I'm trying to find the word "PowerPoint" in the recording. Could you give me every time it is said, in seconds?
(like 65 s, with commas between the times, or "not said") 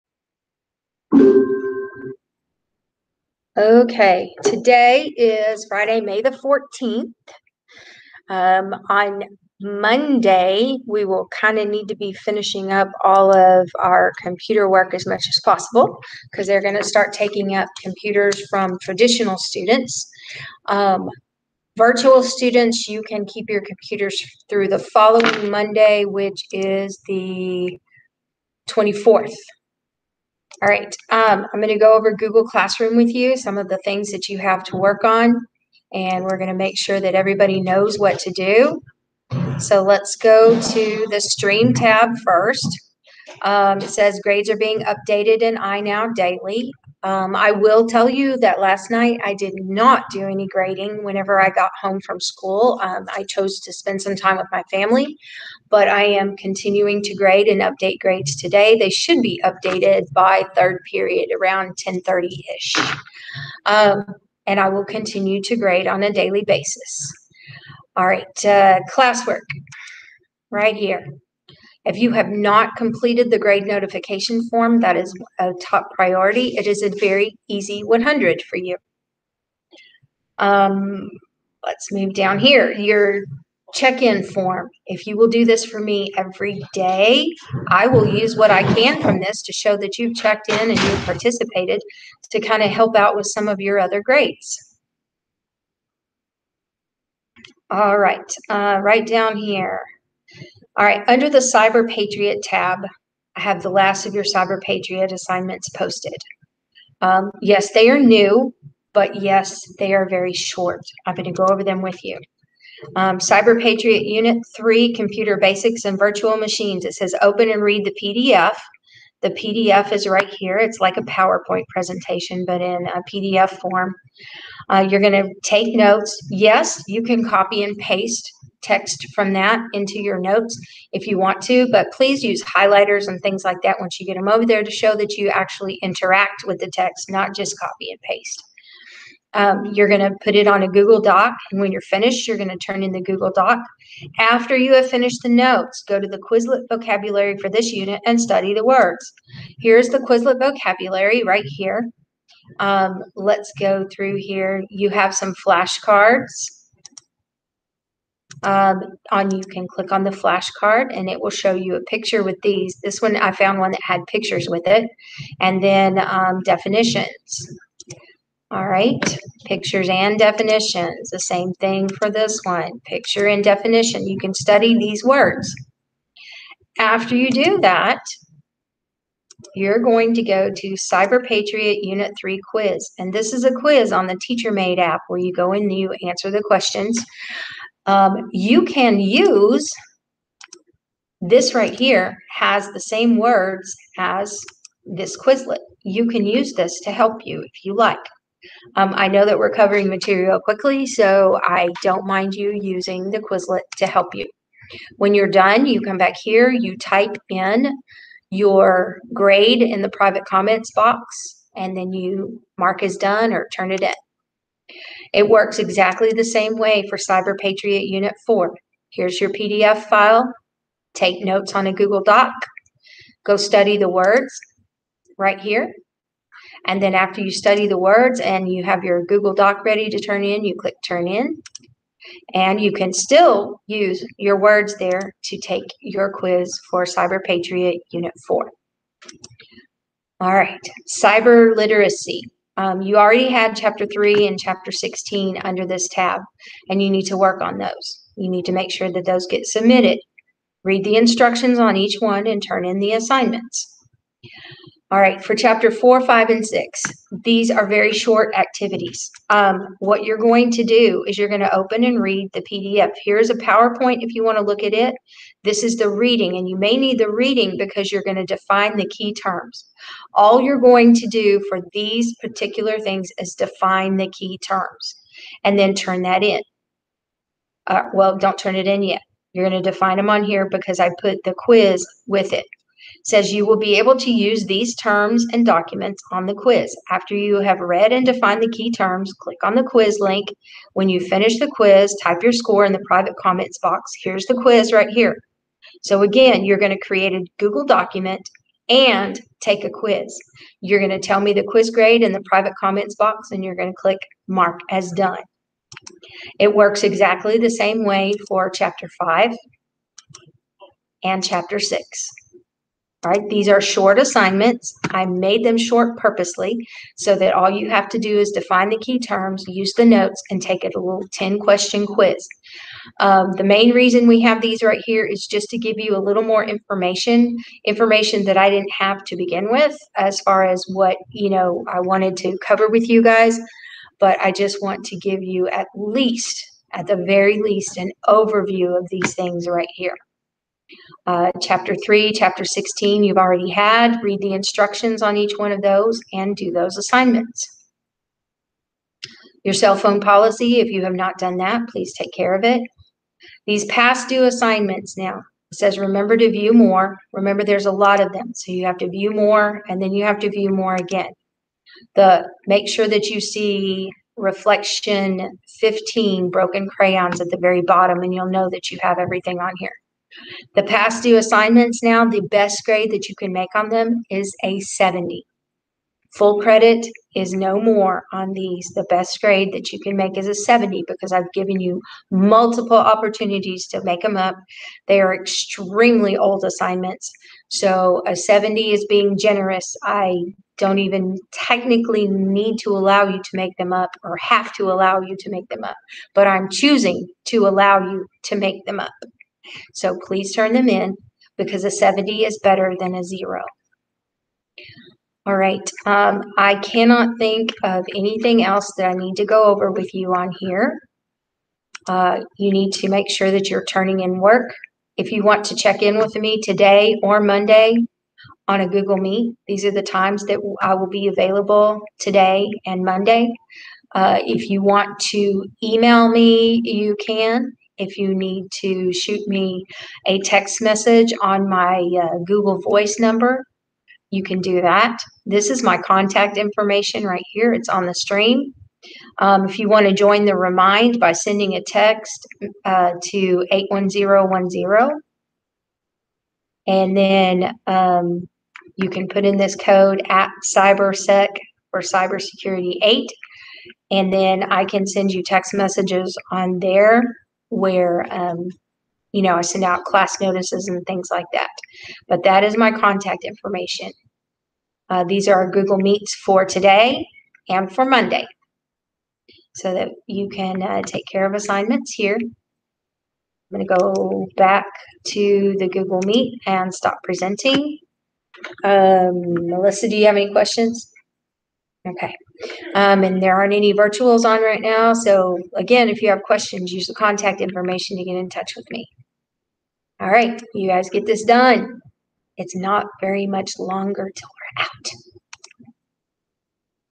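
121 s, 263 s.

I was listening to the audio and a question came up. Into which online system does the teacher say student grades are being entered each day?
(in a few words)
iNow.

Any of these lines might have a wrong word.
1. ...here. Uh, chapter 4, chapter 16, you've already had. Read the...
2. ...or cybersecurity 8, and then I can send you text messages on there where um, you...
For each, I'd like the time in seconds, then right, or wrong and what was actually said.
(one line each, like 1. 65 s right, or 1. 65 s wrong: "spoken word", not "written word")
1. 339 s wrong: "3", not "4"
2. 451 s right.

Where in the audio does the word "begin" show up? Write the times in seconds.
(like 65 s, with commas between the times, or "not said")
329 s.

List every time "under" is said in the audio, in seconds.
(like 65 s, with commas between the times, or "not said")
101 s, 245 s.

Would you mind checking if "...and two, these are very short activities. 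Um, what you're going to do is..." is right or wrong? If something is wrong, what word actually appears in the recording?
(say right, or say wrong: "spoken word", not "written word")
wrong: "six", not "two".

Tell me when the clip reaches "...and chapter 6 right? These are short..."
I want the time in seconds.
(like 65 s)
311 s.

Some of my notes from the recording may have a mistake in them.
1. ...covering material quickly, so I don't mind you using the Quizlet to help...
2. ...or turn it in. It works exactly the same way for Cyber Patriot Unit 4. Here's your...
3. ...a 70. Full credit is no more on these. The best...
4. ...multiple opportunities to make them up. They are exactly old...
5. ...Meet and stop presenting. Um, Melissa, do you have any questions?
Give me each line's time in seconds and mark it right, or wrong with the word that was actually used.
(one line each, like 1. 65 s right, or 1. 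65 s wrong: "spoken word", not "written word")
1. 199 s right
2. 213 s right
3. 374 s right
4. 382 s wrong: "extremely", not "exactly"
5. 476 s right.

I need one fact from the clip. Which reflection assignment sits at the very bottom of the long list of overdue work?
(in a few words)
Reflection 15 Broken Crayons.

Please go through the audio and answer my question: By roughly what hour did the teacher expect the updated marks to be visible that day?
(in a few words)
10:30.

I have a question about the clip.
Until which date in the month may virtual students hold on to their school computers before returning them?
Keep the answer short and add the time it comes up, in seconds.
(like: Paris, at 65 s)
24th, at 27 s.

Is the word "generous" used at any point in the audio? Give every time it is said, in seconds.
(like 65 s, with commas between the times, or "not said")
389 s.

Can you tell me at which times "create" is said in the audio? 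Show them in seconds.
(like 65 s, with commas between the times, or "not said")
296 s.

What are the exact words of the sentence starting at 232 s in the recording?
And you can still use your words there to take your quiz for Cyber Patriot Unit 4.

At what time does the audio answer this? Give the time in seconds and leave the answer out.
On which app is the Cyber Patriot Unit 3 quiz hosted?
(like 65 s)
184 s.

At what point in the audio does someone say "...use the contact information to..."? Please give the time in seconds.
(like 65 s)
486 s.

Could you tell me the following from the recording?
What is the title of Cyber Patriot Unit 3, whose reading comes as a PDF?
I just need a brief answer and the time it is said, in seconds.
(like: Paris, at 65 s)
Computer Basics and Virtual Machines, at 114 s.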